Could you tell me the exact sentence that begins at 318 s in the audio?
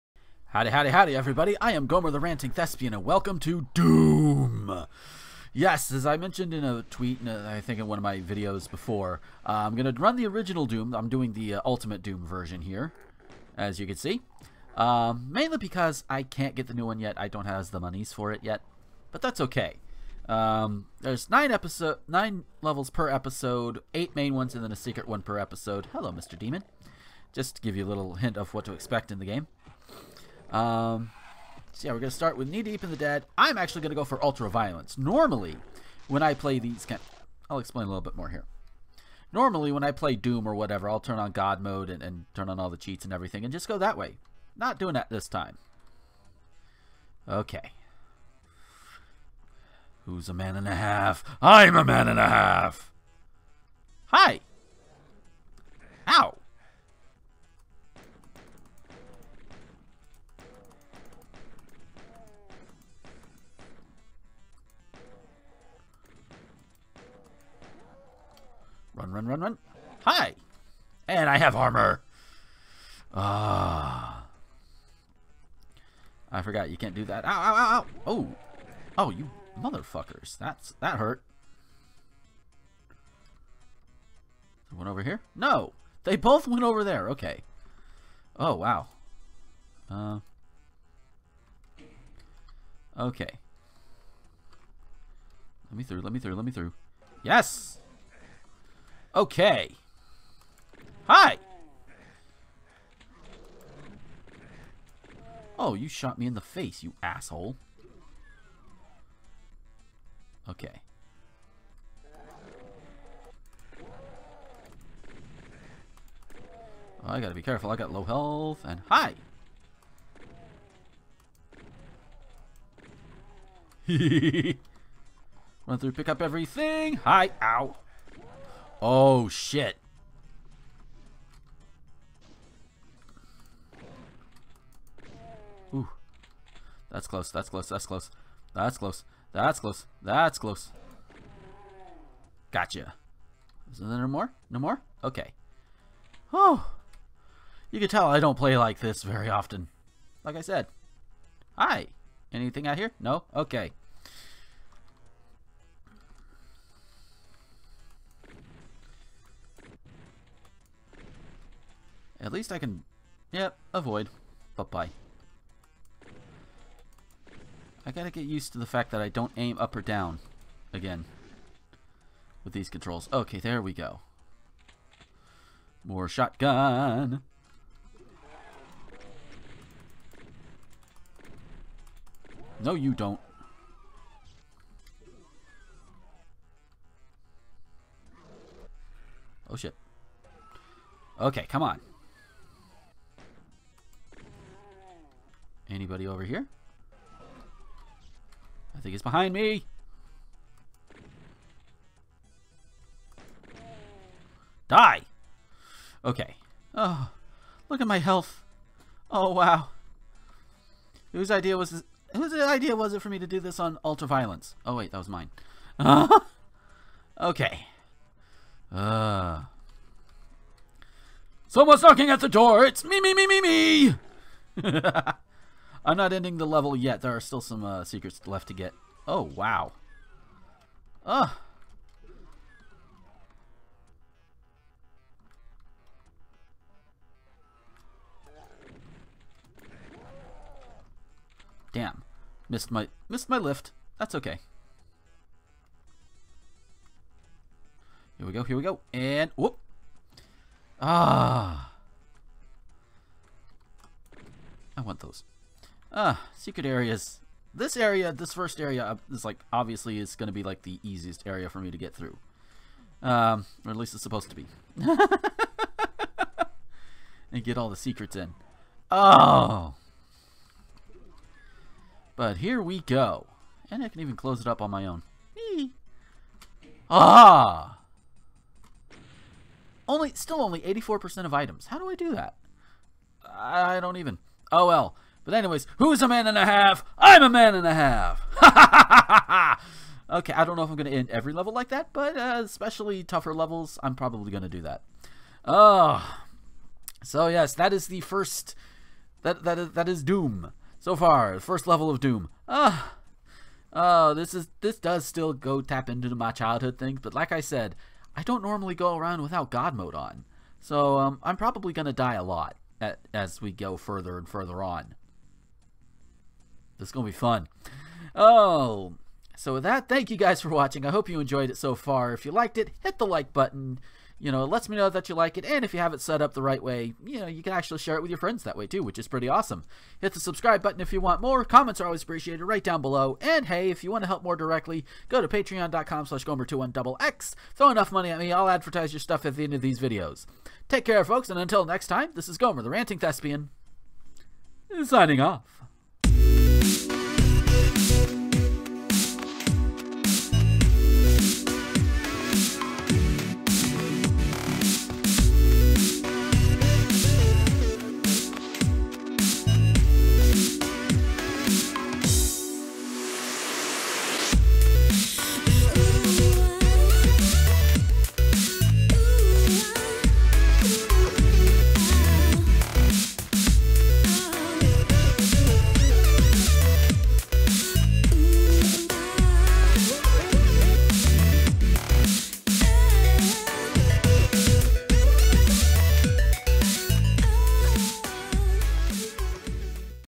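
Oh, so with that, thank you guys for watching.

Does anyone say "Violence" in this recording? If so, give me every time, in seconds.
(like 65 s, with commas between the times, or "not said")
34 s, 214 s.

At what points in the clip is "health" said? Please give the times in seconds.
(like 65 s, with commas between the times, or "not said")
118 s, 207 s.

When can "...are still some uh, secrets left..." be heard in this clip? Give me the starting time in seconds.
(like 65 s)
227 s.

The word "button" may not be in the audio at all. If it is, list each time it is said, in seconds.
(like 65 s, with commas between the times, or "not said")
323 s, 330 s.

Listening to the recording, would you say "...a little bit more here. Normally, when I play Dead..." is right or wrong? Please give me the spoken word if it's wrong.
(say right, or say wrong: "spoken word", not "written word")
wrong: "Doom", not "Dead".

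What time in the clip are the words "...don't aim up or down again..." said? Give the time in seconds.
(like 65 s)
169 s.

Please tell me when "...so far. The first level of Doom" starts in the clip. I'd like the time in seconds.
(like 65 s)
300 s.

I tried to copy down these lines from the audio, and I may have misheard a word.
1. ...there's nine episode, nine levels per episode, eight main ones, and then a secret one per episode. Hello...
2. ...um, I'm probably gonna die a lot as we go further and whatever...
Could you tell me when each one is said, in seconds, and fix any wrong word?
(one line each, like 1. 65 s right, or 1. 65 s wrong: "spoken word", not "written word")
1. 20 s right
2. 310 s wrong: "further", not "whatever".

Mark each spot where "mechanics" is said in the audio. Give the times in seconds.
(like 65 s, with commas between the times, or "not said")
not said.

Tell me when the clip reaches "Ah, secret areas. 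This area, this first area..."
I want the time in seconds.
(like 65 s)
255 s.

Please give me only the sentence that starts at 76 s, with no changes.
I forgot you can't do that.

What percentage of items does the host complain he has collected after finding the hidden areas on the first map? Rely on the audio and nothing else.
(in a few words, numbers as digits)
84%.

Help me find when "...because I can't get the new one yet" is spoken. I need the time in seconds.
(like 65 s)
15 s.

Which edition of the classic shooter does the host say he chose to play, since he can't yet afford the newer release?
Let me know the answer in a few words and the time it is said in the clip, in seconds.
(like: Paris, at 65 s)
Ultimate Doom, at 11 s.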